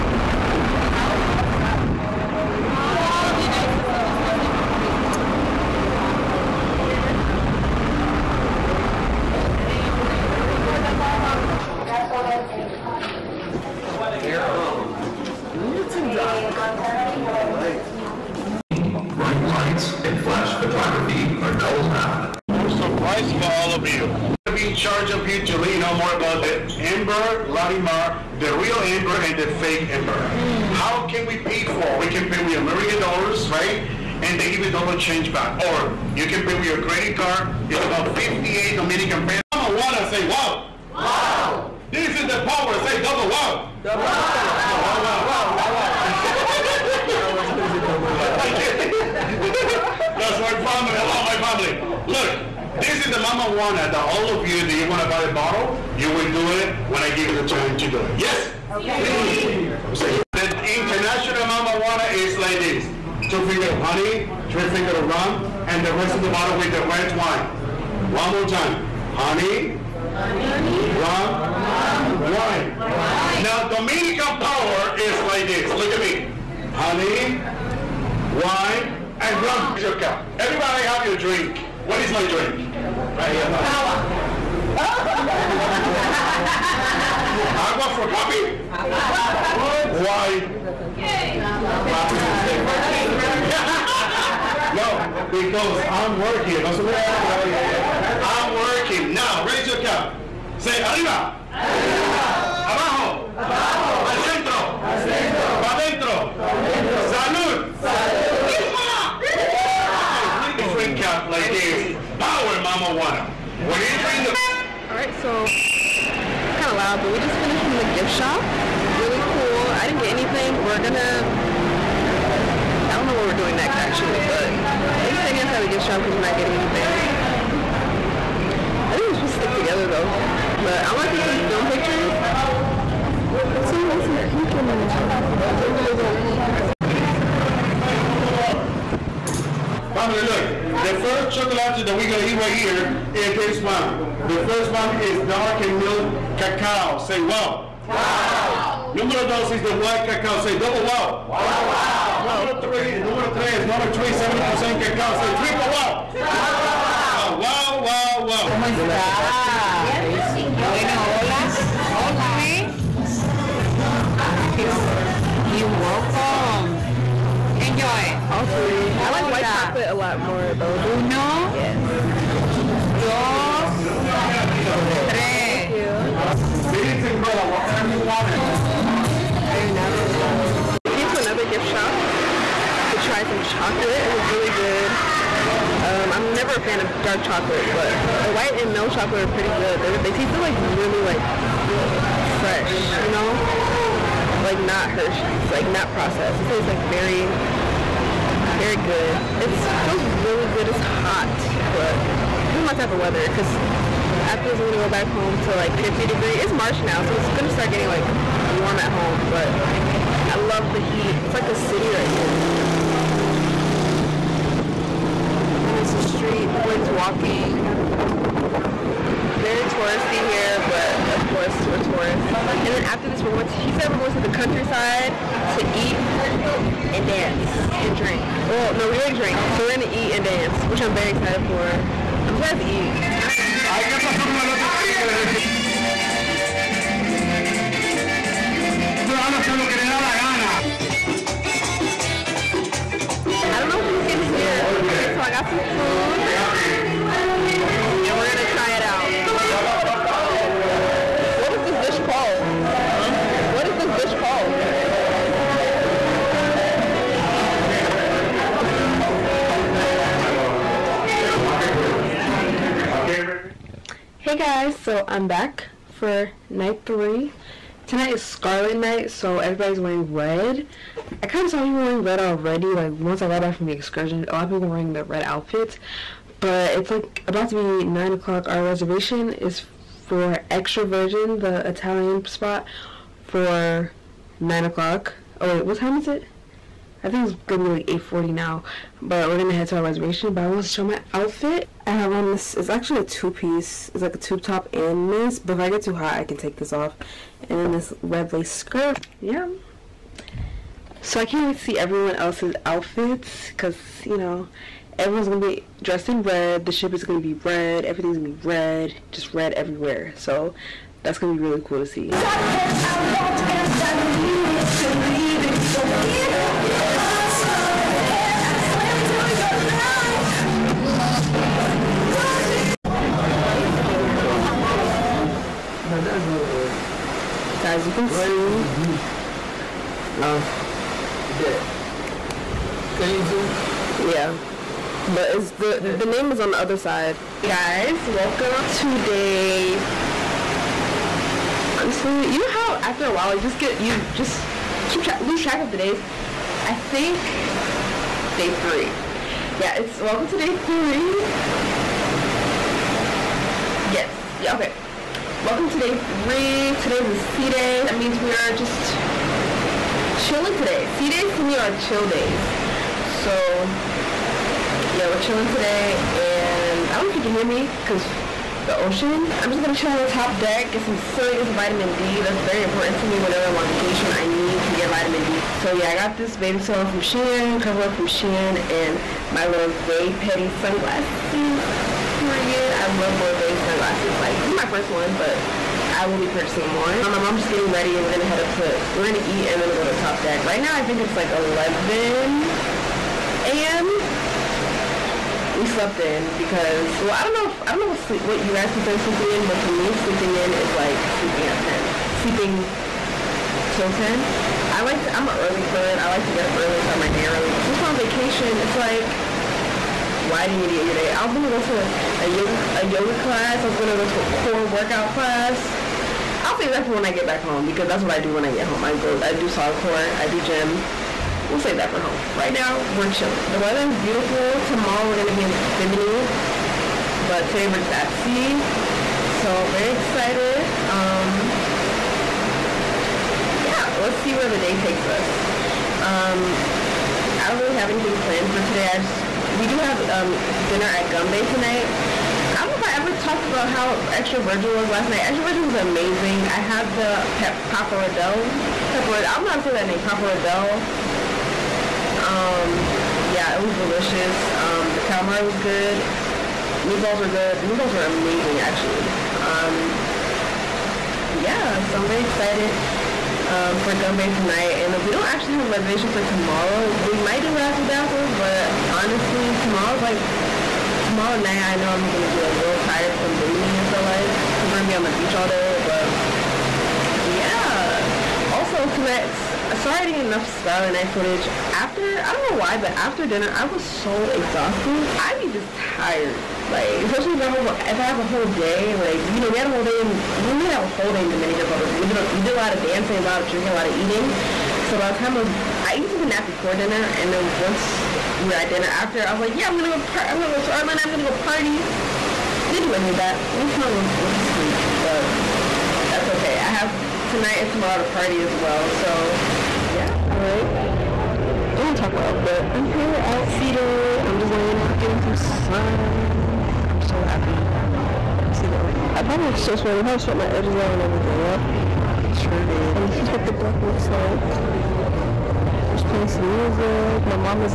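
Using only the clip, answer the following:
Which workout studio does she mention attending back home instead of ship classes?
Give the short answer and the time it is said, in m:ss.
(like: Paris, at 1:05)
SolidCore, at 6:59.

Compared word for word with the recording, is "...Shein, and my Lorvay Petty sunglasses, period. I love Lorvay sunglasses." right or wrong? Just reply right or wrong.
right.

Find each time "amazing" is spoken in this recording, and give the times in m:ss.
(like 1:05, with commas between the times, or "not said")
7:25, 7:38.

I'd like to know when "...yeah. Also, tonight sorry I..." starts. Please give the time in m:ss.
7:57.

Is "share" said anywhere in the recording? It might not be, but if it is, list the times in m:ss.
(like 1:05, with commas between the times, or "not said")
not said.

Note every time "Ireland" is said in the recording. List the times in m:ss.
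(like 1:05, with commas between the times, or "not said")
8:20.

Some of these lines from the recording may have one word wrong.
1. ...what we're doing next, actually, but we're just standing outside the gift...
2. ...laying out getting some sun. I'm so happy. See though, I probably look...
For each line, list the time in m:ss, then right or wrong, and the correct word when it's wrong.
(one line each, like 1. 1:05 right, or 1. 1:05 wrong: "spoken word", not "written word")
1. 2:03 right
2. 8:34 right.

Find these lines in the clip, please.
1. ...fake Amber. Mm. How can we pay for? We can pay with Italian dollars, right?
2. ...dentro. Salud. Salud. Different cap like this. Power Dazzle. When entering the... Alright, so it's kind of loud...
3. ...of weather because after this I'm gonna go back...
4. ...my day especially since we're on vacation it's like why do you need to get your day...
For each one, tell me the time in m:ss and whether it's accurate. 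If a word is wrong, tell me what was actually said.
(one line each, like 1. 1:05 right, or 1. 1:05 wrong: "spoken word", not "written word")
1. 0:29 wrong: "American", not "Italian"
2. 1:45 wrong: "Mamajuana", not "Dazzle"
3. 3:22 right
4. 6:46 wrong: "early", not "especially".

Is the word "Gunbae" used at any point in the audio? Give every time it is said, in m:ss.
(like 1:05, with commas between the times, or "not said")
7:21, 7:43.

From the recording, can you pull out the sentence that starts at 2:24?
The first one is dark and milk cacao.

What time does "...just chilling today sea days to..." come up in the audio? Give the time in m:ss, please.
5:58.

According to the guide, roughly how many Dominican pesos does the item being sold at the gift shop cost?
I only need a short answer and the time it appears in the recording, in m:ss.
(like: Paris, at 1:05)
58, at 0:38.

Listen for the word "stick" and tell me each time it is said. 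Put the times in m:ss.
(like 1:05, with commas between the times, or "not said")
2:09.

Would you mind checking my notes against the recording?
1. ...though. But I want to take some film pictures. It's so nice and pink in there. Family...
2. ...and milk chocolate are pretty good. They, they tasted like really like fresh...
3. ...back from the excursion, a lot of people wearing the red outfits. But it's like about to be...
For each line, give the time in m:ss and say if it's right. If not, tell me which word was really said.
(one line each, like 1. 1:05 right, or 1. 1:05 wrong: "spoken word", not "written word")
1. 2:09 right
2. 3:08 right
3. 4:33 right.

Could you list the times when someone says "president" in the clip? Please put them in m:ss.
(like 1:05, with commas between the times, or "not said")
not said.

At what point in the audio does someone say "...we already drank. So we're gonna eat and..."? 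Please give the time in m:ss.
3:48.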